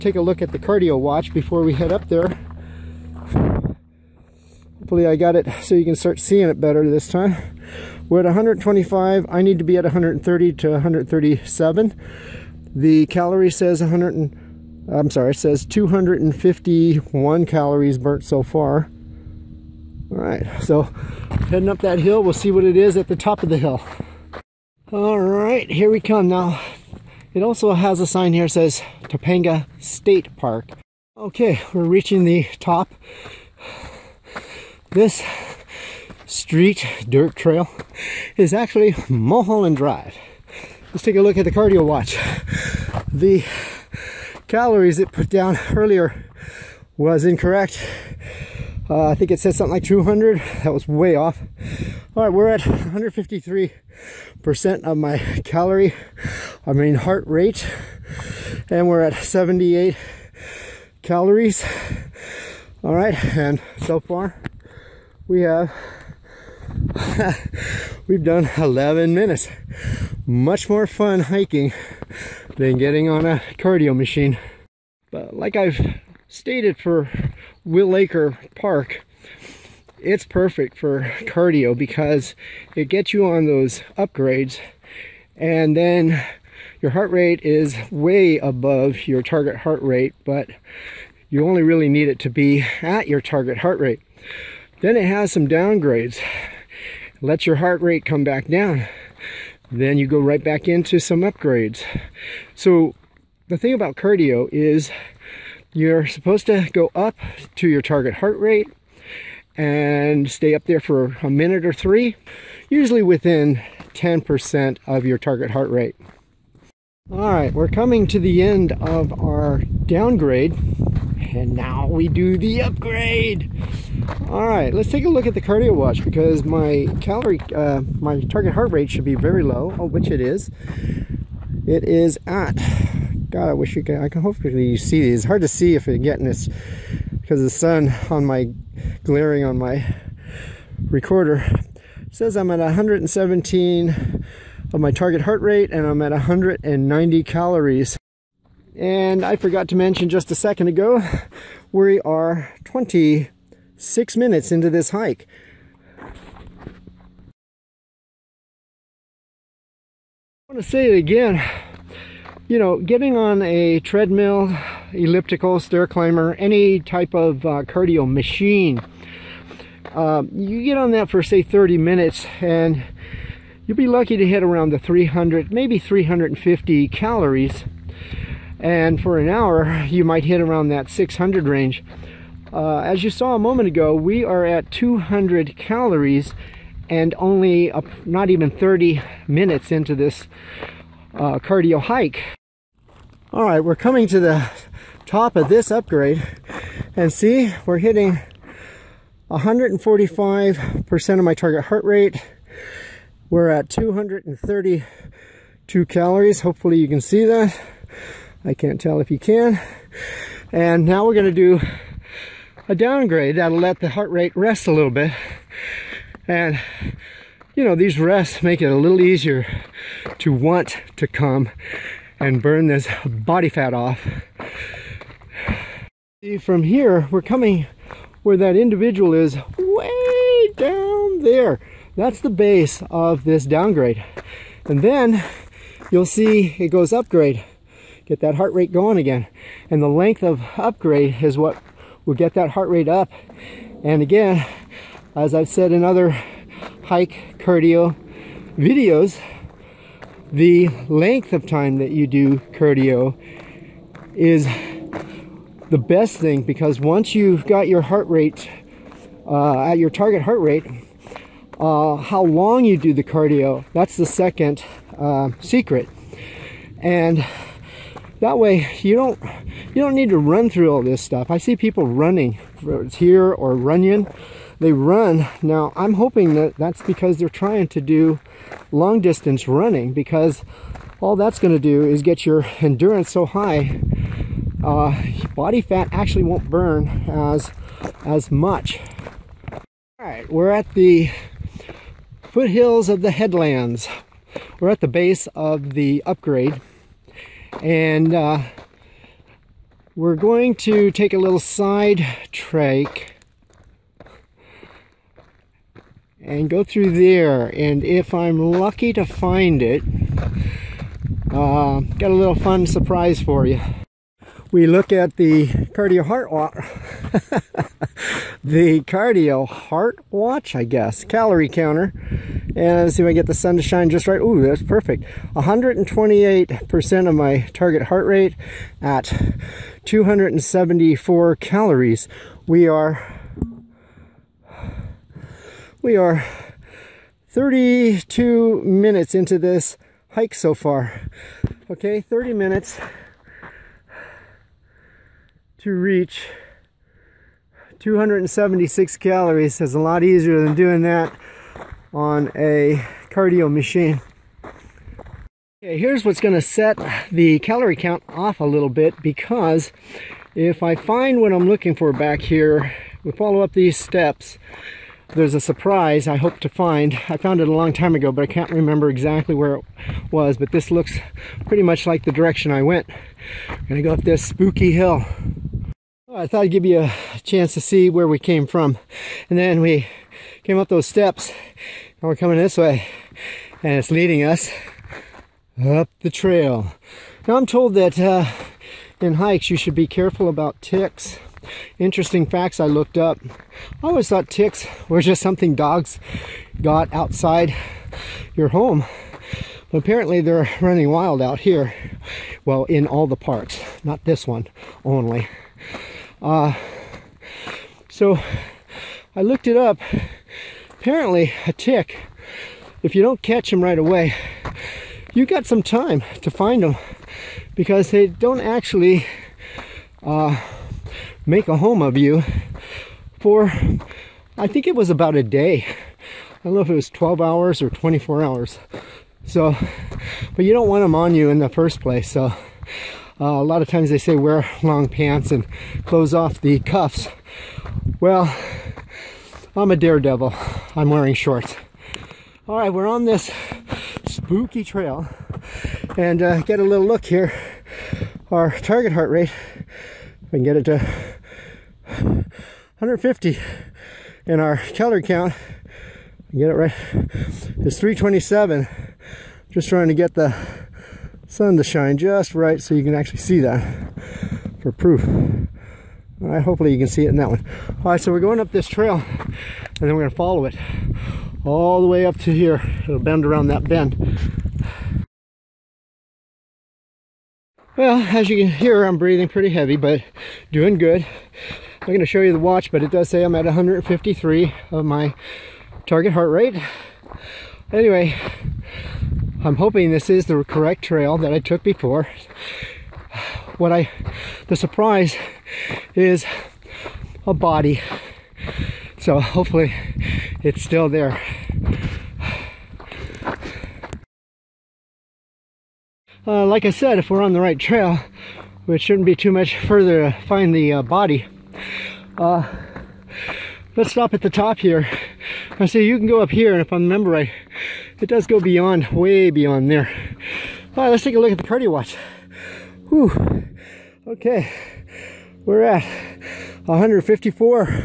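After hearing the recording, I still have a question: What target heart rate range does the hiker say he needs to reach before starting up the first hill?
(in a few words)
130 to 137.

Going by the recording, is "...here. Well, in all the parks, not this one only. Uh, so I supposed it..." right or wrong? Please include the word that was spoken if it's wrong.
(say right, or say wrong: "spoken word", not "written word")
wrong: "looked", not "supposed".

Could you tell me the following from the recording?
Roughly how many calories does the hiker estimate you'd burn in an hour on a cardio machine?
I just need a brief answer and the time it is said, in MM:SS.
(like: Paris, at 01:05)
600, at 03:00.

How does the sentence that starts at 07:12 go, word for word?
So uh, a lot of times they say wear long pants and close off the cuffs.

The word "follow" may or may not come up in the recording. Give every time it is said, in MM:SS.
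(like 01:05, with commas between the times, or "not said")
06:03, 07:50.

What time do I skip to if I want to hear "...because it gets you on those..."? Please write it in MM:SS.
01:21.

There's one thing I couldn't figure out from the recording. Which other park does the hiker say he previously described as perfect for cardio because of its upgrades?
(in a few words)
Wilacre Park.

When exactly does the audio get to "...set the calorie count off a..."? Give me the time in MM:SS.
05:56.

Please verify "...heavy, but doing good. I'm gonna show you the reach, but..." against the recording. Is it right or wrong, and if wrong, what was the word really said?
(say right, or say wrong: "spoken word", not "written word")
wrong: "watch", not "reach".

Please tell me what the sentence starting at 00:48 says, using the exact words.
Uh, I think it said something like 200.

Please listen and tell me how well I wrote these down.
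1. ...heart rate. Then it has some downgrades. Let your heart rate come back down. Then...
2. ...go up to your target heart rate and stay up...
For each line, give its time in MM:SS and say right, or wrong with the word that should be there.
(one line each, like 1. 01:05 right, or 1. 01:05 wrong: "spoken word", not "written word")
1. 01:33 right
2. 01:46 right.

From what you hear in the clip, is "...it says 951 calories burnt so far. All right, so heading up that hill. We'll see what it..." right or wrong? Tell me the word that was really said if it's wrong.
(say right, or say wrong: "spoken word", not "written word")
wrong: "251", not "951".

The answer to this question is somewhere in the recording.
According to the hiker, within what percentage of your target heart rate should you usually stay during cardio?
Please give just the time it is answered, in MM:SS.
01:53.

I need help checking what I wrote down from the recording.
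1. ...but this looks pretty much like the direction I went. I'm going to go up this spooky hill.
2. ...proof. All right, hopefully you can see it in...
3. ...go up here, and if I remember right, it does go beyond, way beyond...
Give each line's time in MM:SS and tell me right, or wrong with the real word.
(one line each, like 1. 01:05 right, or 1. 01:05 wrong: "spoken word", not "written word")
1. 06:10 right
2. 07:44 right
3. 08:36 right.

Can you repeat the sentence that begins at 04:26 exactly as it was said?
And that way you don't you don't need to run through all this stuff.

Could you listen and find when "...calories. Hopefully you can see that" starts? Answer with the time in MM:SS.
03:25.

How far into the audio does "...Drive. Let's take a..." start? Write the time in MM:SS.
00:39.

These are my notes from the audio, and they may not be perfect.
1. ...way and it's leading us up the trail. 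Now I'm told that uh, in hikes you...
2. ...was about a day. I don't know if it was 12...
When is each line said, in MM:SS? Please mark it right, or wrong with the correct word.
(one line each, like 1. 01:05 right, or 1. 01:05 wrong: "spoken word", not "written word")
1. 06:22 right
2. 07:04 right.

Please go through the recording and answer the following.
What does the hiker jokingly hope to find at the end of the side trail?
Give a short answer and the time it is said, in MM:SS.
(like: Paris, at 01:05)
A body, at 08:17.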